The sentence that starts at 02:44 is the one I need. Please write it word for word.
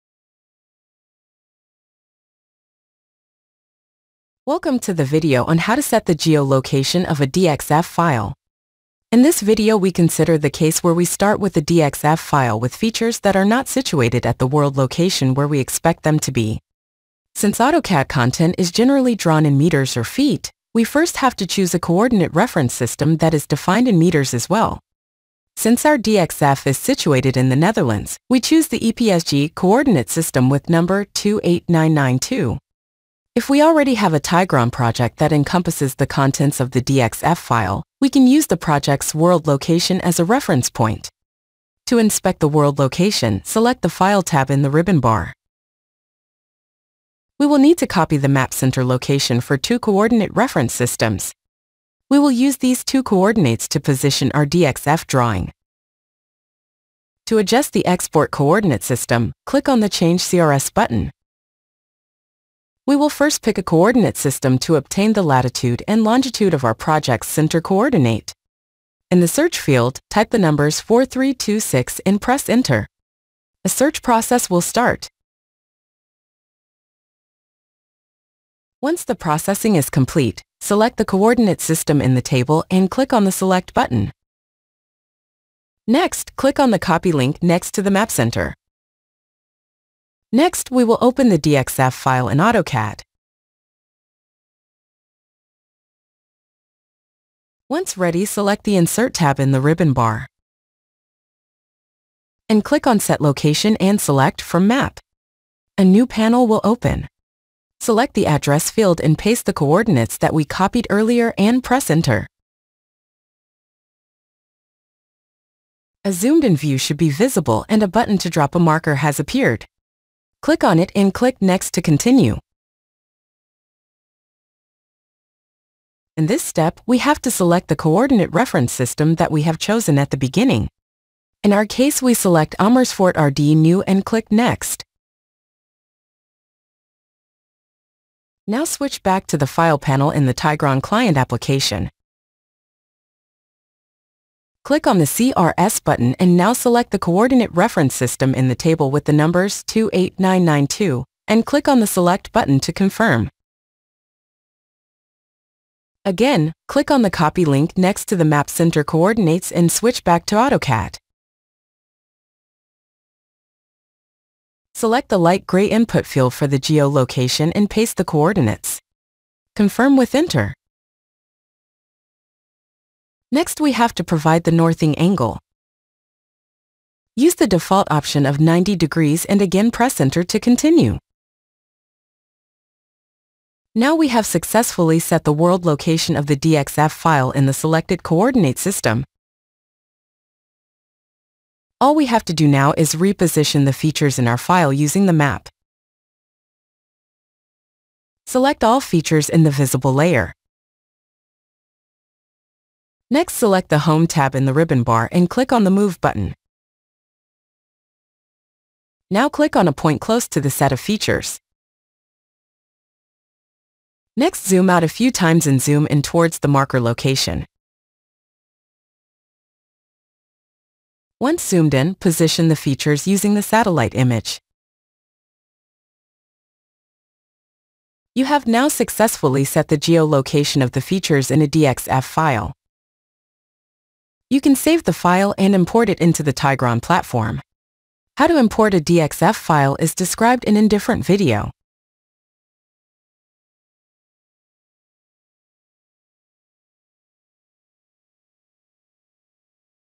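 Select the light gray input field for the geolocation and paste the coordinates.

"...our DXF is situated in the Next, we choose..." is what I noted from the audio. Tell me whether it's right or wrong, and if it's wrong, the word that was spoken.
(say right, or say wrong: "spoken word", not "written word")
wrong: "Netherlands", not "Next".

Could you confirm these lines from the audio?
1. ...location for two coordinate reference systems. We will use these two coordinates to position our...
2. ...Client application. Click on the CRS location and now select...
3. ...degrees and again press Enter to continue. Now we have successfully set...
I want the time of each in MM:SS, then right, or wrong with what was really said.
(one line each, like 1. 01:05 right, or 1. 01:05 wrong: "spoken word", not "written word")
1. 00:48 right
2. 02:20 wrong: "button", not "location"
3. 02:58 right.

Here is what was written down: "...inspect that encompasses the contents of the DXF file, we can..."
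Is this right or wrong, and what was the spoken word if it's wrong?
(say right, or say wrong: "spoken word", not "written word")
wrong: "project", not "inspect".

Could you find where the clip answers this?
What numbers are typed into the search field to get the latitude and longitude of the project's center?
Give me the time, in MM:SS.
01:10.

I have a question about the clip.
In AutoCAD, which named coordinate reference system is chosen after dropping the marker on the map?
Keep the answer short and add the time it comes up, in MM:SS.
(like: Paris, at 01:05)
Amersfoort RD New, at 02:12.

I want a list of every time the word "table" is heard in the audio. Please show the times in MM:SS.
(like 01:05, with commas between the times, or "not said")
01:22, 02:28.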